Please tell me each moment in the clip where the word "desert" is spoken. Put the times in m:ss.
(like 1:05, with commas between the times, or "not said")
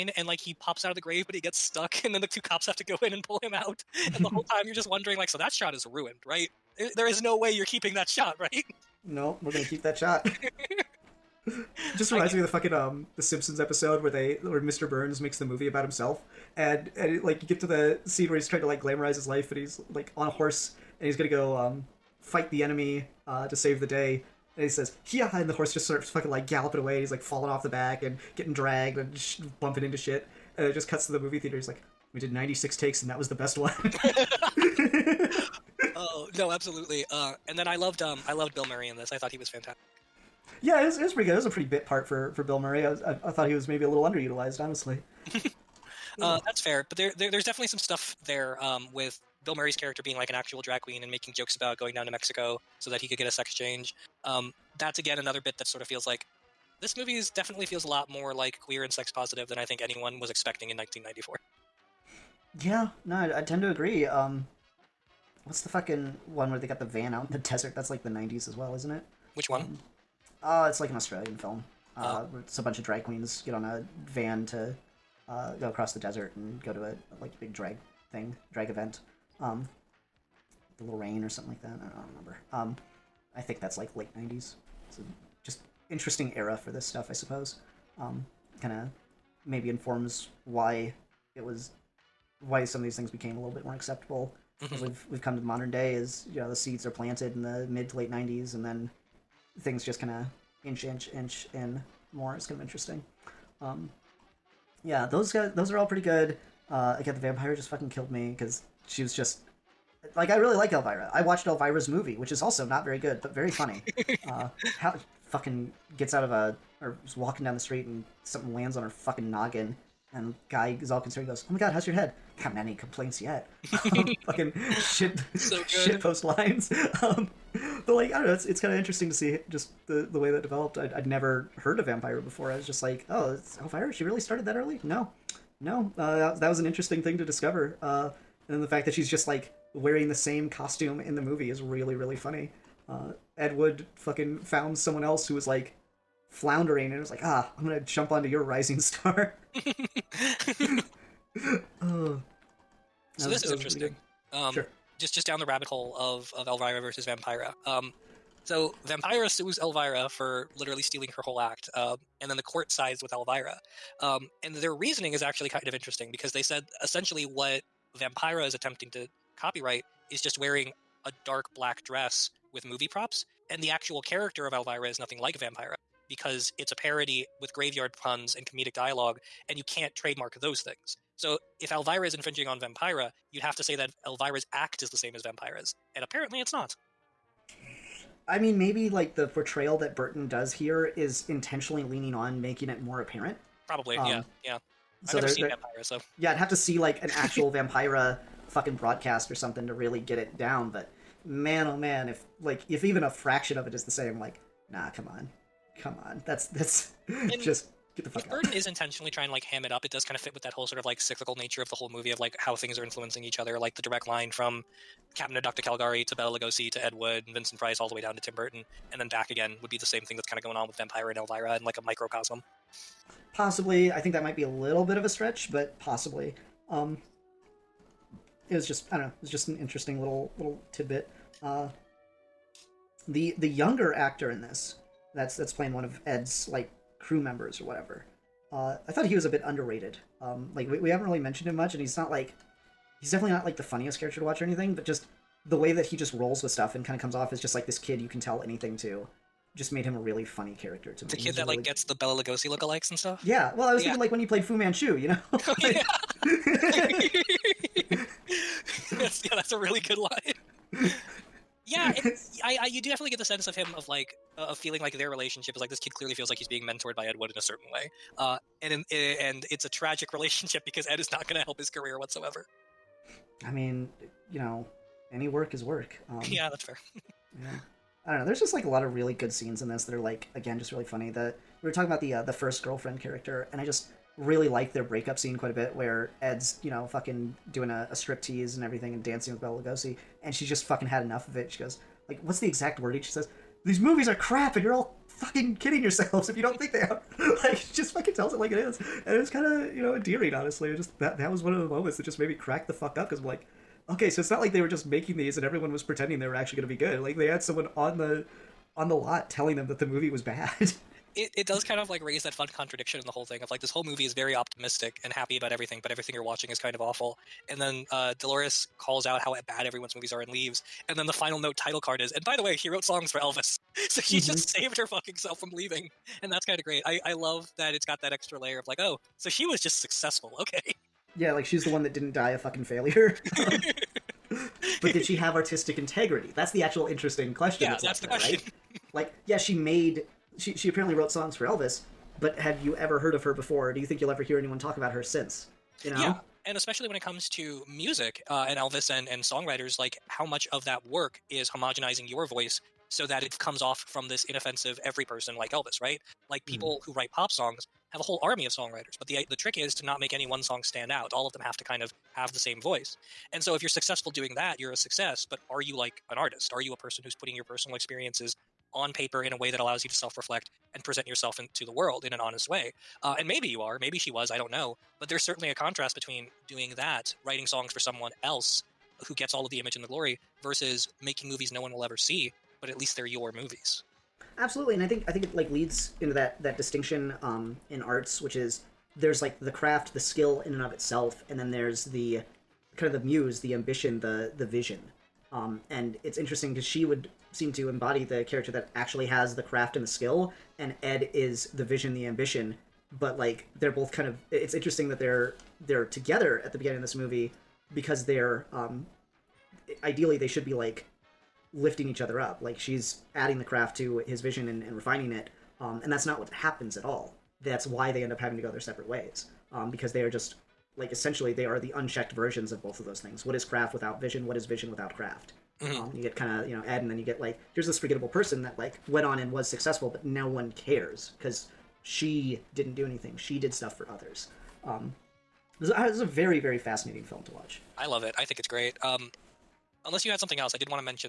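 1:07, 1:15.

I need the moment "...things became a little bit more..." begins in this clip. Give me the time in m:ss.
1:32.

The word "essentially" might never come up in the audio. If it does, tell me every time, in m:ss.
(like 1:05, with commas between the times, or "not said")
2:46, 7:00.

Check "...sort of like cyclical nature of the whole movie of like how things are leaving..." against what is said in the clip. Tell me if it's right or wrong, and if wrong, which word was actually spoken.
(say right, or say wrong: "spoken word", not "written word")
wrong: "influencing", not "leaving".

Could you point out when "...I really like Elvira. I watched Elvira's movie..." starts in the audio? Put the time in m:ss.
1:50.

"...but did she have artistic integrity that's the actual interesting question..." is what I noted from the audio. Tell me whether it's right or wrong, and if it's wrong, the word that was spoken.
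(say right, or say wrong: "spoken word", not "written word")
right.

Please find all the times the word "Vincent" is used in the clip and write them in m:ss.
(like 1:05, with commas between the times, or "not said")
3:37.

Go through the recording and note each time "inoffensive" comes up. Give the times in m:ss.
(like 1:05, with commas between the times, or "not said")
5:54.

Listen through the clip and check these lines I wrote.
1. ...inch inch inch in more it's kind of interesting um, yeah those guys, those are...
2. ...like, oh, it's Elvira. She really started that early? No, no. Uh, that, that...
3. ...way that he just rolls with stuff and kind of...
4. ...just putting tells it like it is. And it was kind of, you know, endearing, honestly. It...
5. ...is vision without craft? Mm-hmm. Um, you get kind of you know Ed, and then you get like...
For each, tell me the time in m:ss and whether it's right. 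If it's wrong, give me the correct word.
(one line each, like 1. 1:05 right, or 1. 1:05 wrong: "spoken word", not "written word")
1. 1:40 right
2. 2:12 right
3. 4:05 right
4. 4:57 wrong: "fucking", not "putting"
5. 7:04 right.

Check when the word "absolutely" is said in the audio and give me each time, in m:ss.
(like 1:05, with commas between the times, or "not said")
0:36, 6:24.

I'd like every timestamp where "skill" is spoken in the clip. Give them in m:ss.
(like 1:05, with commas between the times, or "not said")
6:29, 6:39.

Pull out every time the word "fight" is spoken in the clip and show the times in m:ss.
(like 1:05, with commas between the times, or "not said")
0:22.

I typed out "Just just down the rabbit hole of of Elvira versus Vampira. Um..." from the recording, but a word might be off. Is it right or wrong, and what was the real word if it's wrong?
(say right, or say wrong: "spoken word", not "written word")
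right.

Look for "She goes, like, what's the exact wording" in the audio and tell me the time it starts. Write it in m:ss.
4:51.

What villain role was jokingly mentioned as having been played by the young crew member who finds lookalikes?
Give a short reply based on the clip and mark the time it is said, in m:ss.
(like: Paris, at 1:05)
Fu Manchu, at 4:14.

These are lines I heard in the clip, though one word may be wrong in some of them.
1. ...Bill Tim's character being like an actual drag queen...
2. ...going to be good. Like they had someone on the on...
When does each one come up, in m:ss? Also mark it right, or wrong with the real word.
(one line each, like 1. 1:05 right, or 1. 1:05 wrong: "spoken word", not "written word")
1. 0:49 wrong: "Murray", not "Tim"
2. 5:06 right.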